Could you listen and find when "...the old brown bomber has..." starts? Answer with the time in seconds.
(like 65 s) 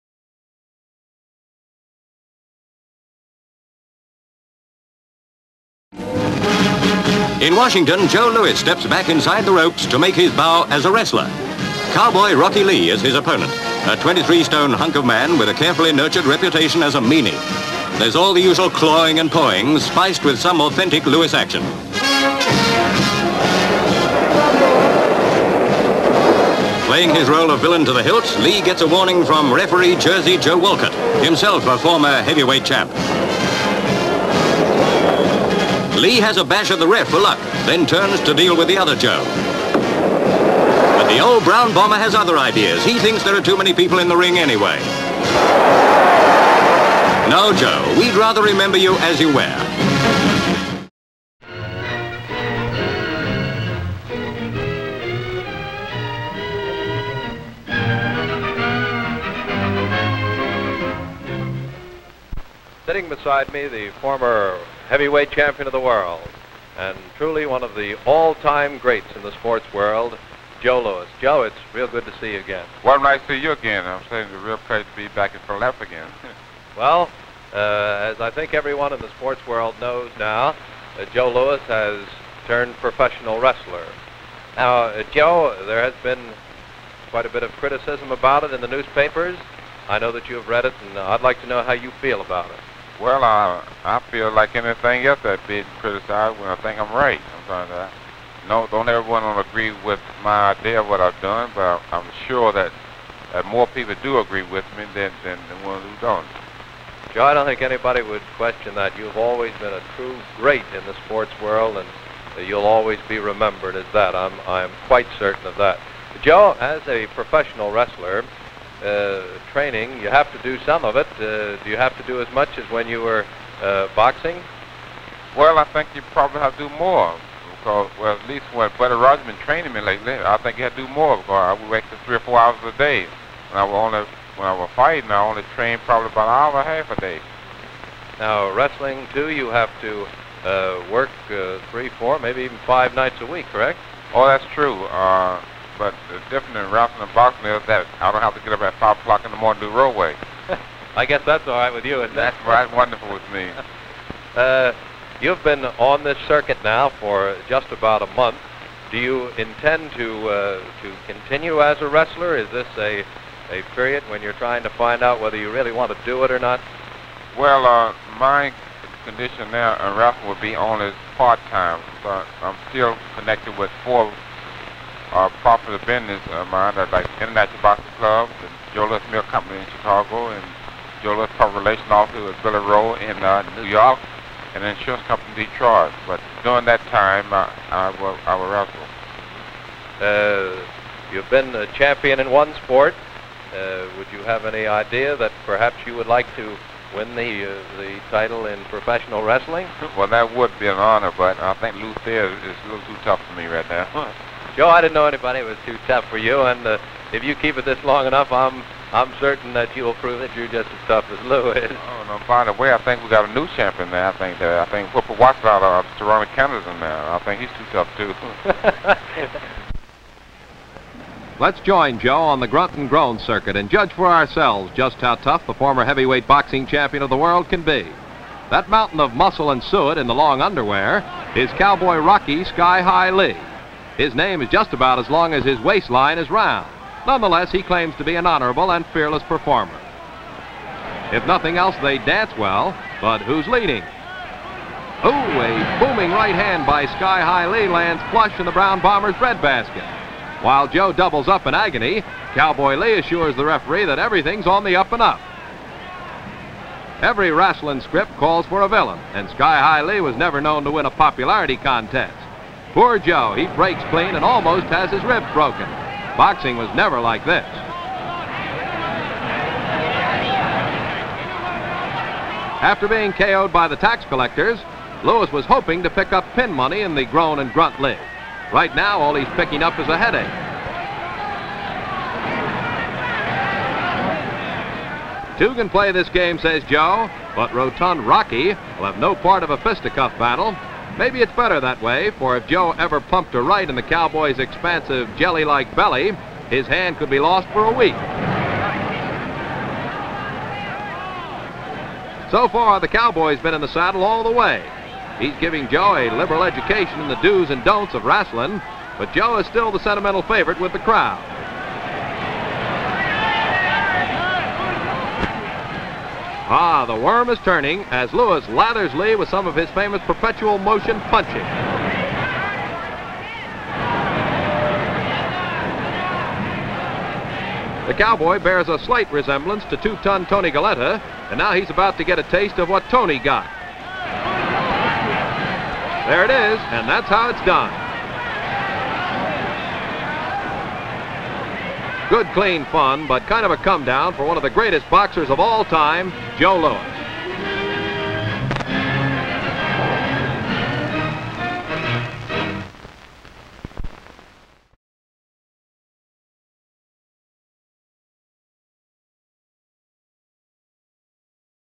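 41 s.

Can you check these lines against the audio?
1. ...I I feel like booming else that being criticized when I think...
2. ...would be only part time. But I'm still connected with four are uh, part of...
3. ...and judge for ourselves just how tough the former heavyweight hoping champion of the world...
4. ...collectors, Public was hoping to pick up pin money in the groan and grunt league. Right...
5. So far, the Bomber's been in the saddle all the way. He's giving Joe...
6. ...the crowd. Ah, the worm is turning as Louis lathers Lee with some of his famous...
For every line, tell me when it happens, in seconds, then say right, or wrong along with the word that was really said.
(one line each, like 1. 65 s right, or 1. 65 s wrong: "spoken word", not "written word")
1. 93 s wrong: "anything", not "booming"
2. 170 s right
3. 223 s wrong: "boxing", not "hoping"
4. 274 s wrong: "Louis", not "Public"
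5. 302 s wrong: "Cowboy", not "Bomber"
6. 310 s right.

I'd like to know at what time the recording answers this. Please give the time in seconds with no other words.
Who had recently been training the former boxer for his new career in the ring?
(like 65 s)
128 s.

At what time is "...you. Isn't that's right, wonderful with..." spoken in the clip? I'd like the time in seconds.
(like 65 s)
151 s.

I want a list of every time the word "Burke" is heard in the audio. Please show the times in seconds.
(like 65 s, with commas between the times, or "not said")
not said.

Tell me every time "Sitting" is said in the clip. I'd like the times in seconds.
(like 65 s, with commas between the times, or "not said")
62 s.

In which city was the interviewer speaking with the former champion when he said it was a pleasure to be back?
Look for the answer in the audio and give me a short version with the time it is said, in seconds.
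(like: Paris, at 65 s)
Philadelphia, at 75 s.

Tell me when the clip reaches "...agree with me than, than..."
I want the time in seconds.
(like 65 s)
104 s.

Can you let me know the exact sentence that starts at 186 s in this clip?
But during that time, uh, I, was, I was wrestle.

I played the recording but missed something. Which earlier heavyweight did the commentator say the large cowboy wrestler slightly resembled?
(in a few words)
Tony Galento.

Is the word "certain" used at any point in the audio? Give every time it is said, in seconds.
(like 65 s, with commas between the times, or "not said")
115 s, 209 s.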